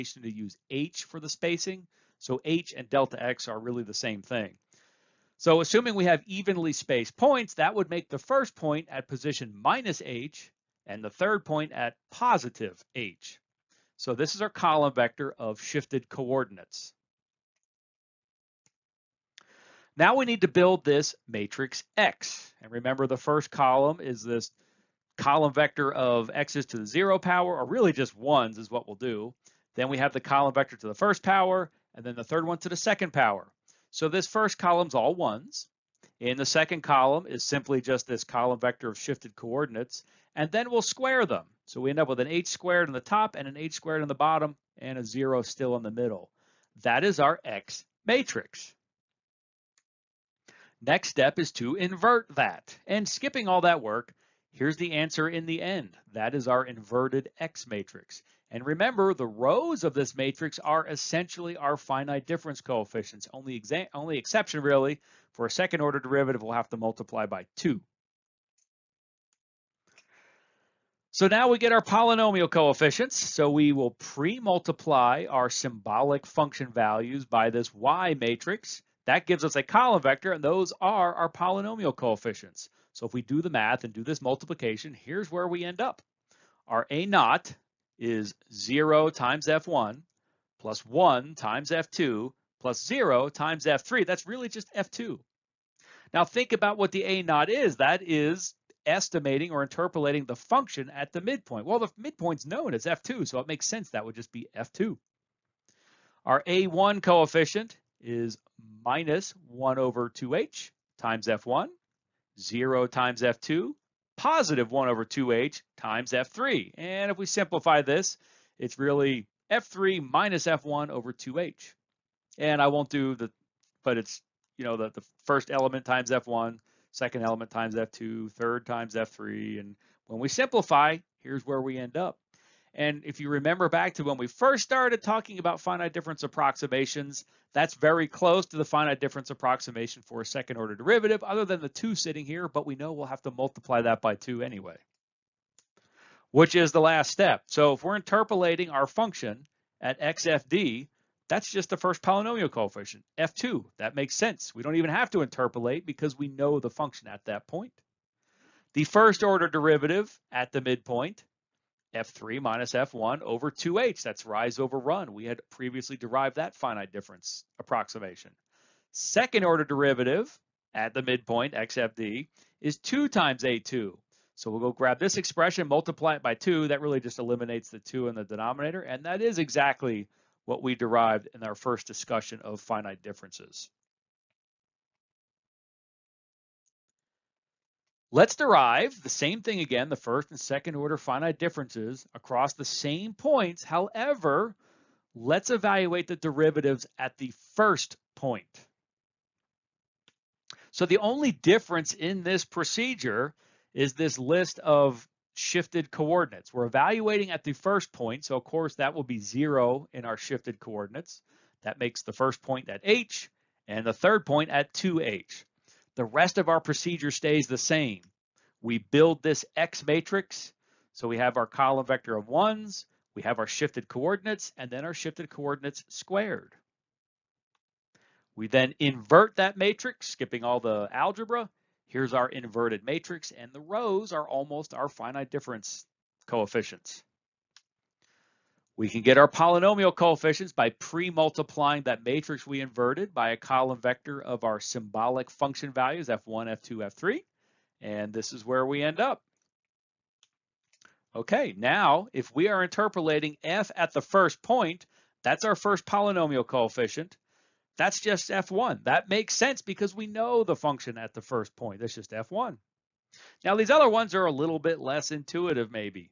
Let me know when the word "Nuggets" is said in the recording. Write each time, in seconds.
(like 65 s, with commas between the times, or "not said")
not said.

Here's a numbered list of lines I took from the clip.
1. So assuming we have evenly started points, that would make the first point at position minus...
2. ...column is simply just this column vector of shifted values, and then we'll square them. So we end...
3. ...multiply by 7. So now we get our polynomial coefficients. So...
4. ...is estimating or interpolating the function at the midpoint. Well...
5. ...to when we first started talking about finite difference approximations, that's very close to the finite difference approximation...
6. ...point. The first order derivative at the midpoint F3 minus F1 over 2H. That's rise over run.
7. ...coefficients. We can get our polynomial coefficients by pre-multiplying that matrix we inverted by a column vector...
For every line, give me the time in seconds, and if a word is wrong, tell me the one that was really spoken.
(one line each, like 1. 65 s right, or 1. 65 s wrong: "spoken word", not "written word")
1. 5 s wrong: "spaced", not "started"
2. 36 s wrong: "coordinates", not "values"
3. 66 s wrong: "2", not "7"
4. 98 s right
5. 133 s right
6. 157 s right
7. 236 s right.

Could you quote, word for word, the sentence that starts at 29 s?
Then we have the column vector to the first power, and then the third one to the second power.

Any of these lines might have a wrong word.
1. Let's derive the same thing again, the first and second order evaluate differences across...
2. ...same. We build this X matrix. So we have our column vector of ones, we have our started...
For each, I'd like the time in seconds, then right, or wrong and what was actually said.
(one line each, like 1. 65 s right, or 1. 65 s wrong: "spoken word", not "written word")
1. 188 s wrong: "finite", not "evaluate"
2. 217 s wrong: "shifted", not "started".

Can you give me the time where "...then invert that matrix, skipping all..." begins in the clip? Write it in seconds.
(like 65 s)
228 s.